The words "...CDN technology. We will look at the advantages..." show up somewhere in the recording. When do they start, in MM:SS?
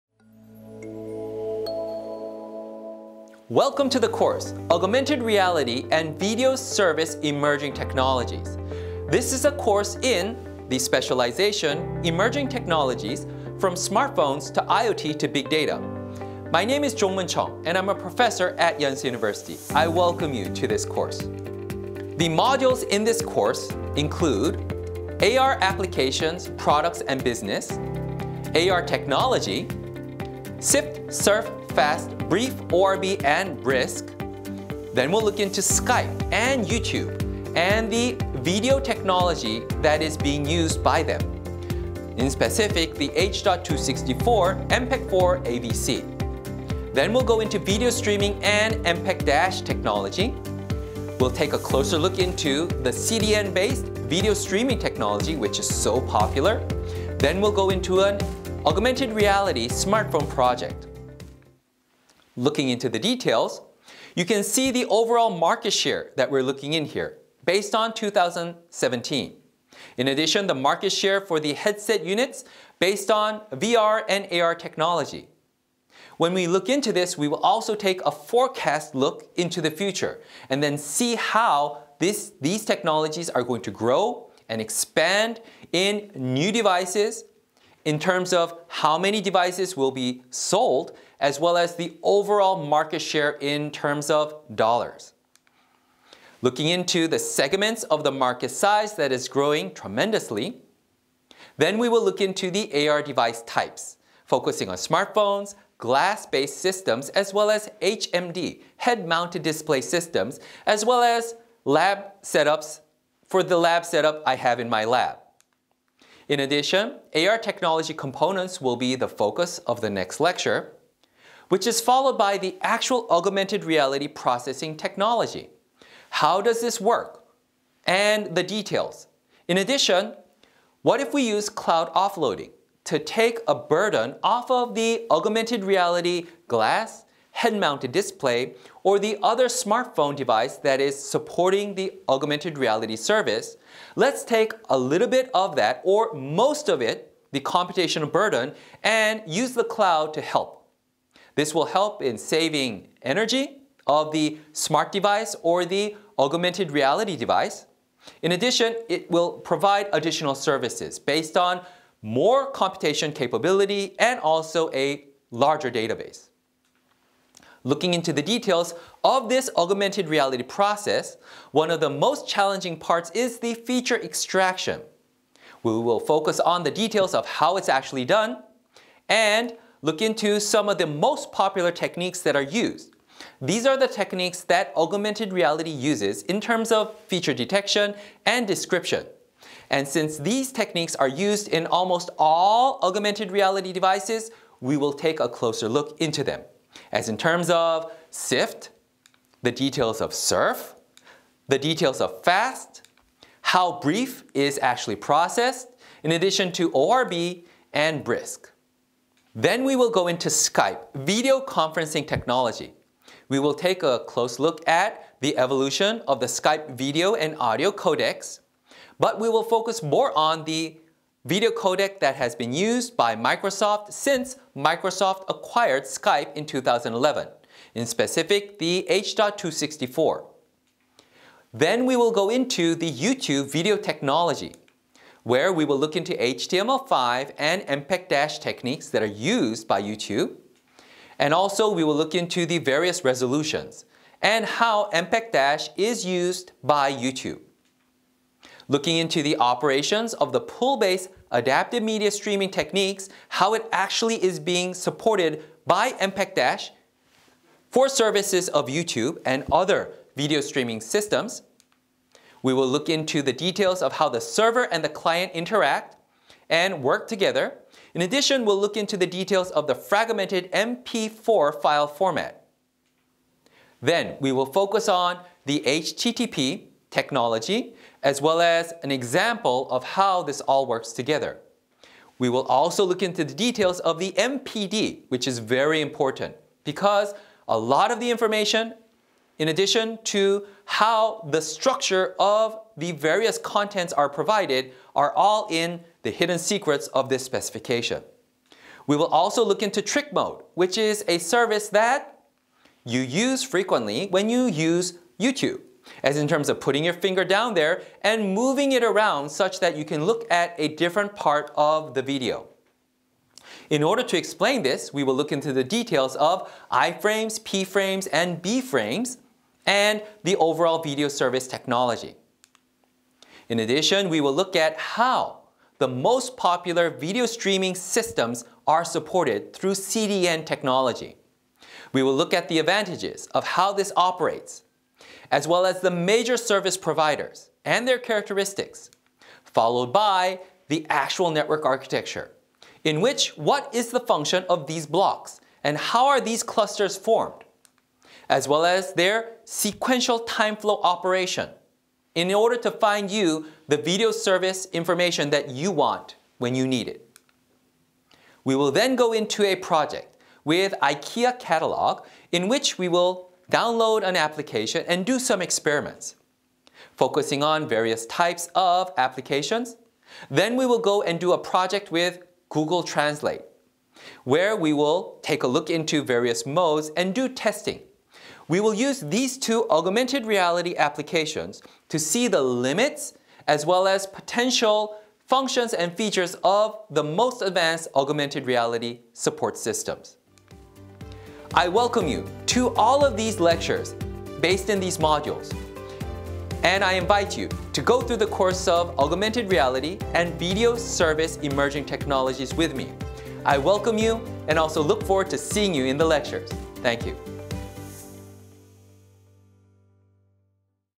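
05:29.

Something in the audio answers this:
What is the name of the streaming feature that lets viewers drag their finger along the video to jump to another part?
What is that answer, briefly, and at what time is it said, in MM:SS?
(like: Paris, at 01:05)
Trick Mode, at 04:59.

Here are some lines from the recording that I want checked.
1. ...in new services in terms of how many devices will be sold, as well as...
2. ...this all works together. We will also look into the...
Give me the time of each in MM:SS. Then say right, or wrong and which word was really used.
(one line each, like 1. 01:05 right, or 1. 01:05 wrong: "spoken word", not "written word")
1. 01:25 wrong: "devices", not "services"
2. 04:40 right.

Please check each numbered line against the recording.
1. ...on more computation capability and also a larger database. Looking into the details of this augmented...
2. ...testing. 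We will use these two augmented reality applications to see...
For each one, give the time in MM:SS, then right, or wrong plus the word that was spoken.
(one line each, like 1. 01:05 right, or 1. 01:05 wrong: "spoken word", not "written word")
1. 02:41 right
2. 06:17 right.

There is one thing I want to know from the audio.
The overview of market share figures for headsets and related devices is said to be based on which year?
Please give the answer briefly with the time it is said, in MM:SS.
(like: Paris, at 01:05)
2017, at 01:07.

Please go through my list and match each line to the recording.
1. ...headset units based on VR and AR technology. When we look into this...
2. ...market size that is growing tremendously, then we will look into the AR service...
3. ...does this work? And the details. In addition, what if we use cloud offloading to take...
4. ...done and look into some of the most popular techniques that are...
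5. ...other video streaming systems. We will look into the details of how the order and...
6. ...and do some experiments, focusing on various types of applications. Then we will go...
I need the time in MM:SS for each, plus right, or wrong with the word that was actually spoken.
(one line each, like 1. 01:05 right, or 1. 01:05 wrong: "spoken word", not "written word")
1. 01:11 right
2. 01:38 wrong: "device", not "service"
3. 02:06 right
4. 02:58 right
5. 04:19 wrong: "server", not "order"
6. 06:04 right.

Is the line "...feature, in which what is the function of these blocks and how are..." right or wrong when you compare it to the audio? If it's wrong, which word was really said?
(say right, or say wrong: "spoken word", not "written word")
wrong: "architecture", not "feature".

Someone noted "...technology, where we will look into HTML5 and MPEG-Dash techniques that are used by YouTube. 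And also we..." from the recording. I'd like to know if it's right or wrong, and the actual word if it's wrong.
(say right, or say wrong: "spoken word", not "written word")
right.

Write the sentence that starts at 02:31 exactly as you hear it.
This will help in saving energy of the smart device or the augmented reality device.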